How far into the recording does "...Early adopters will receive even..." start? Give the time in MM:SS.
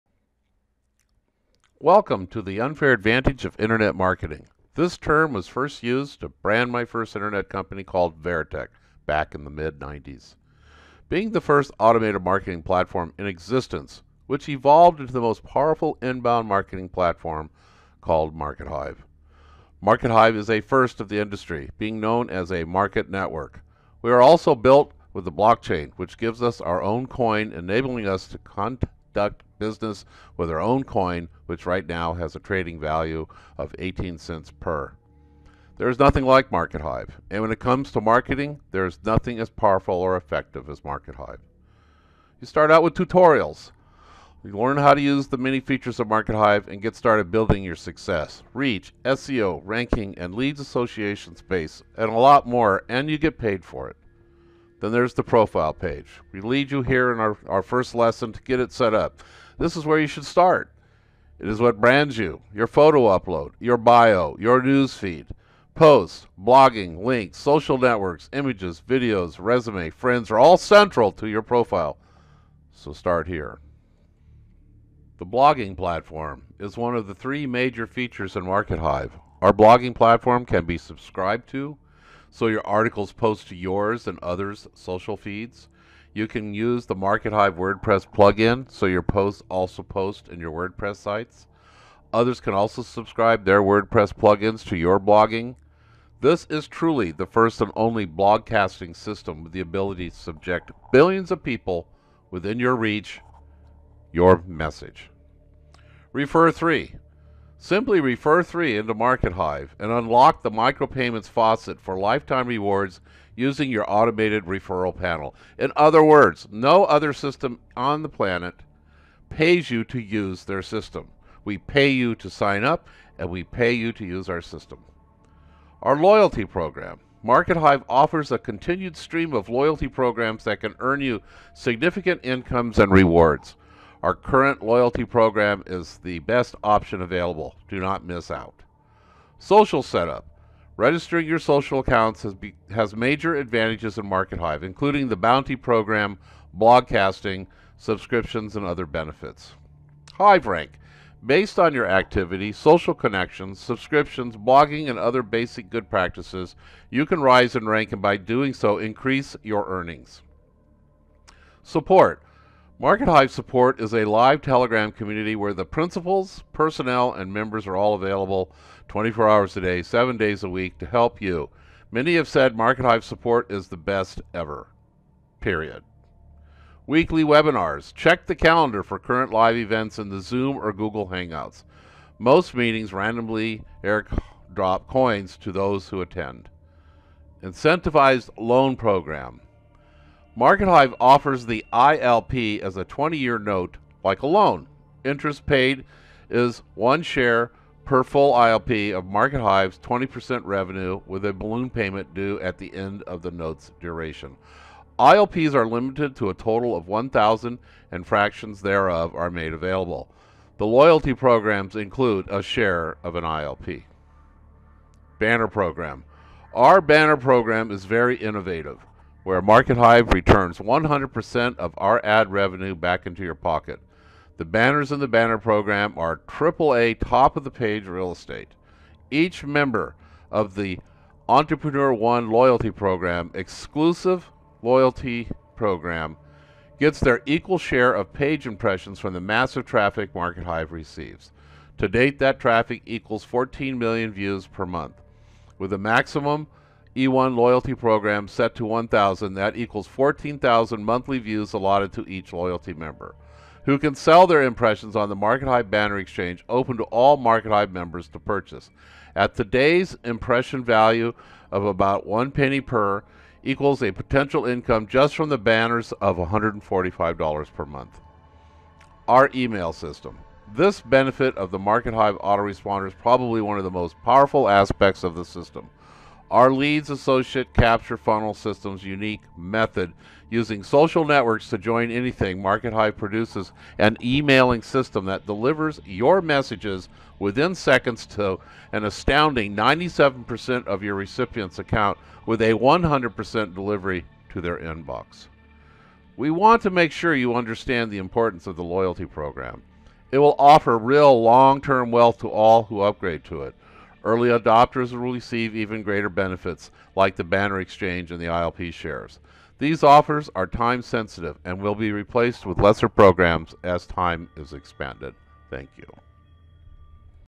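05:04.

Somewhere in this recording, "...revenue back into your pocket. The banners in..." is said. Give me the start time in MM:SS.
03:42.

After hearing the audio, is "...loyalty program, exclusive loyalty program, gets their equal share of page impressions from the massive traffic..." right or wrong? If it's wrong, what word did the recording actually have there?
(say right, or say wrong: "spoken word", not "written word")
right.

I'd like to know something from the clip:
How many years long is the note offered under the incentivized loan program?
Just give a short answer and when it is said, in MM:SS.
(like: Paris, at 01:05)
20 years, at 03:12.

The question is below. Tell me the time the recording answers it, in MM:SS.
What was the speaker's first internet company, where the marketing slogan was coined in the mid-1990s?
00:08.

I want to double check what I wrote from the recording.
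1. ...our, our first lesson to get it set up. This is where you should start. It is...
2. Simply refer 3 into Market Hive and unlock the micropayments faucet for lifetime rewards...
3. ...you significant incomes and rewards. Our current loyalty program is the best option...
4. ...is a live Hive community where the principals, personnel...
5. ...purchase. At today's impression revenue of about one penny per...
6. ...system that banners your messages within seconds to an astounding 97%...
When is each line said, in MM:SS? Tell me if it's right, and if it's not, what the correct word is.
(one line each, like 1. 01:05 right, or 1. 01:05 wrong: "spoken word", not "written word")
1. 00:57 right
2. 01:47 right
3. 02:11 right
4. 02:43 wrong: "Telegram", not "Hive"
5. 04:18 wrong: "value", not "revenue"
6. 04:44 wrong: "delivers", not "banners".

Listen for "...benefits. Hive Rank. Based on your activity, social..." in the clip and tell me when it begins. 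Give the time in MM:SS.
02:28.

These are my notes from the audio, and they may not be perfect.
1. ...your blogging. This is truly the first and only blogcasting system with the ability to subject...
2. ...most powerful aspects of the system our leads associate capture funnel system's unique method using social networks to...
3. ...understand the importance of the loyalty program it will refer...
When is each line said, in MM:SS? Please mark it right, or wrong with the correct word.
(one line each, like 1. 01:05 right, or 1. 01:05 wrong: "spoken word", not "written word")
1. 01:34 right
2. 04:33 right
3. 04:57 wrong: "offer", not "refer".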